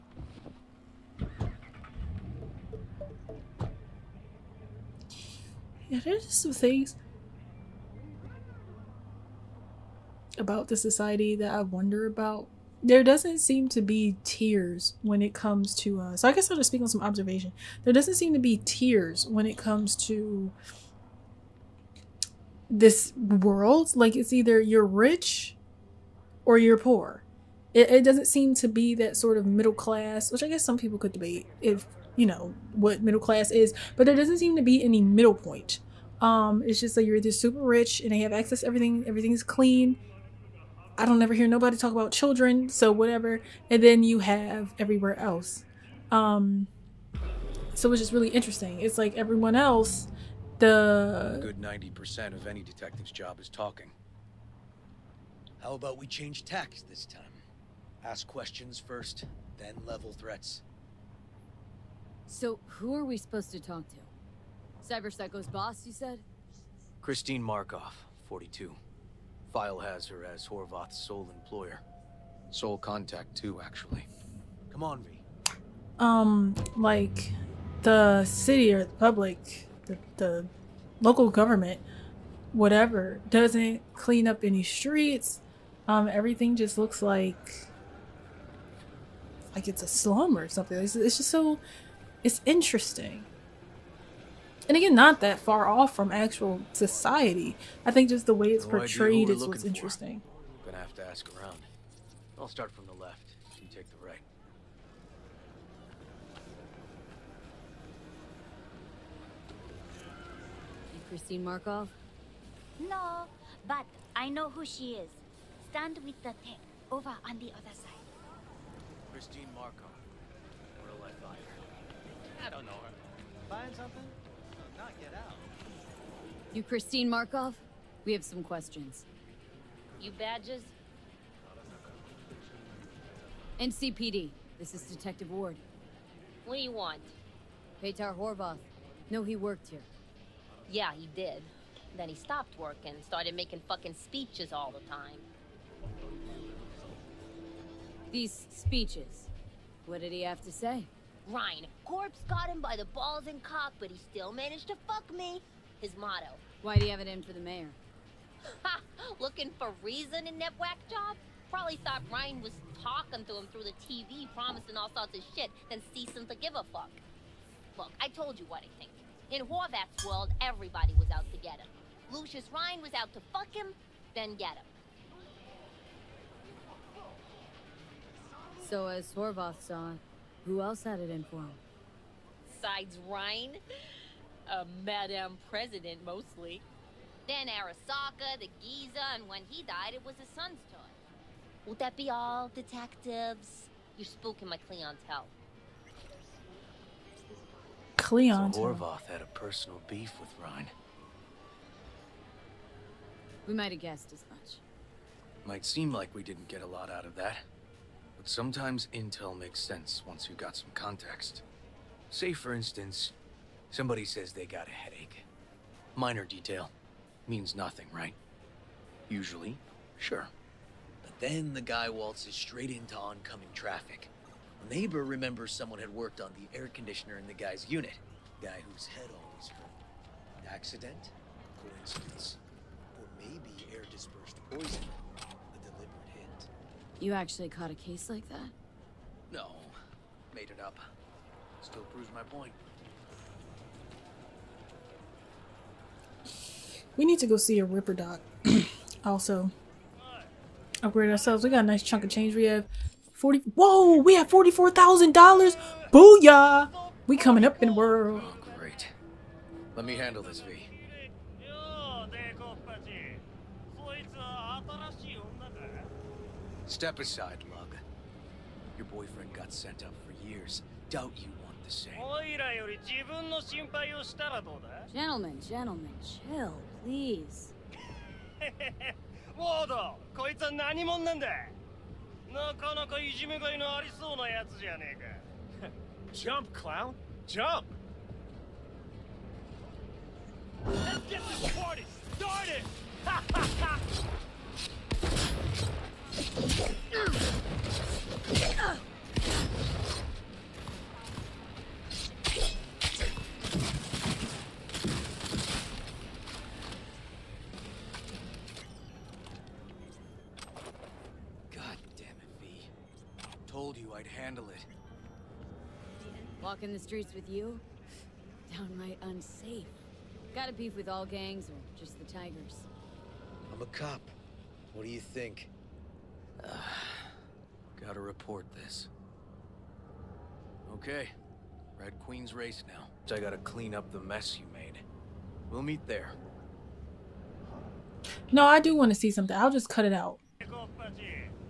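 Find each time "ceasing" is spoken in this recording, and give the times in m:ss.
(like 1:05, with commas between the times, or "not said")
2:45.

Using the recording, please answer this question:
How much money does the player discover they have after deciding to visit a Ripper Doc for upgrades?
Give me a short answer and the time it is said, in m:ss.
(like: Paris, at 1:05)
$44,000, at 4:14.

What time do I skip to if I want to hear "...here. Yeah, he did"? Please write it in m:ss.
2:19.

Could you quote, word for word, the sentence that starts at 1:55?
Stand with the tech over on the other side.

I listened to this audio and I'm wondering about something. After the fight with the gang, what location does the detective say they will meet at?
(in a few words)
Red Queen's race.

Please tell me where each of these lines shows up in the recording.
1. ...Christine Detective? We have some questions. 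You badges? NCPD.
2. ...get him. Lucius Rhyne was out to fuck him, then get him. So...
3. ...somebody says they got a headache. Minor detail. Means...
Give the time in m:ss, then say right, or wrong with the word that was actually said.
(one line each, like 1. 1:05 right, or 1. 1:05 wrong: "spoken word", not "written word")
1. 2:06 wrong: "Markov", not "Detective"
2. 2:51 right
3. 3:33 right.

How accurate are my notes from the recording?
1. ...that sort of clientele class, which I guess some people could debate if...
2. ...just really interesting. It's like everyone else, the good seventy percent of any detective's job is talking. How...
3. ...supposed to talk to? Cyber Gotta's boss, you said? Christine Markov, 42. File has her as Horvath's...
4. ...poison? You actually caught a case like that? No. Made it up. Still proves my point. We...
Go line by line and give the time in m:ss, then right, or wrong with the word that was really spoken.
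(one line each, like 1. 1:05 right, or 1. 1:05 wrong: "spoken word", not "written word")
1. 0:28 wrong: "middle", not "clientele"
2. 0:48 wrong: "ninety", not "seventy"
3. 1:03 wrong: "Psycho", not "Gotta"
4. 3:54 right.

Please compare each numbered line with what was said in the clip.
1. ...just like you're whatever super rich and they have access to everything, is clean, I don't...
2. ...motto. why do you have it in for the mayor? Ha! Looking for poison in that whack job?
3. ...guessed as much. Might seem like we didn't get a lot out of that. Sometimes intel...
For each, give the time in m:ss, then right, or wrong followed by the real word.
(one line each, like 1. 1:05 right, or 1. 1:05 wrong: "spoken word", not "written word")
1. 0:36 wrong: "either", not "whatever"
2. 2:35 wrong: "reason", not "poison"
3. 3:23 right.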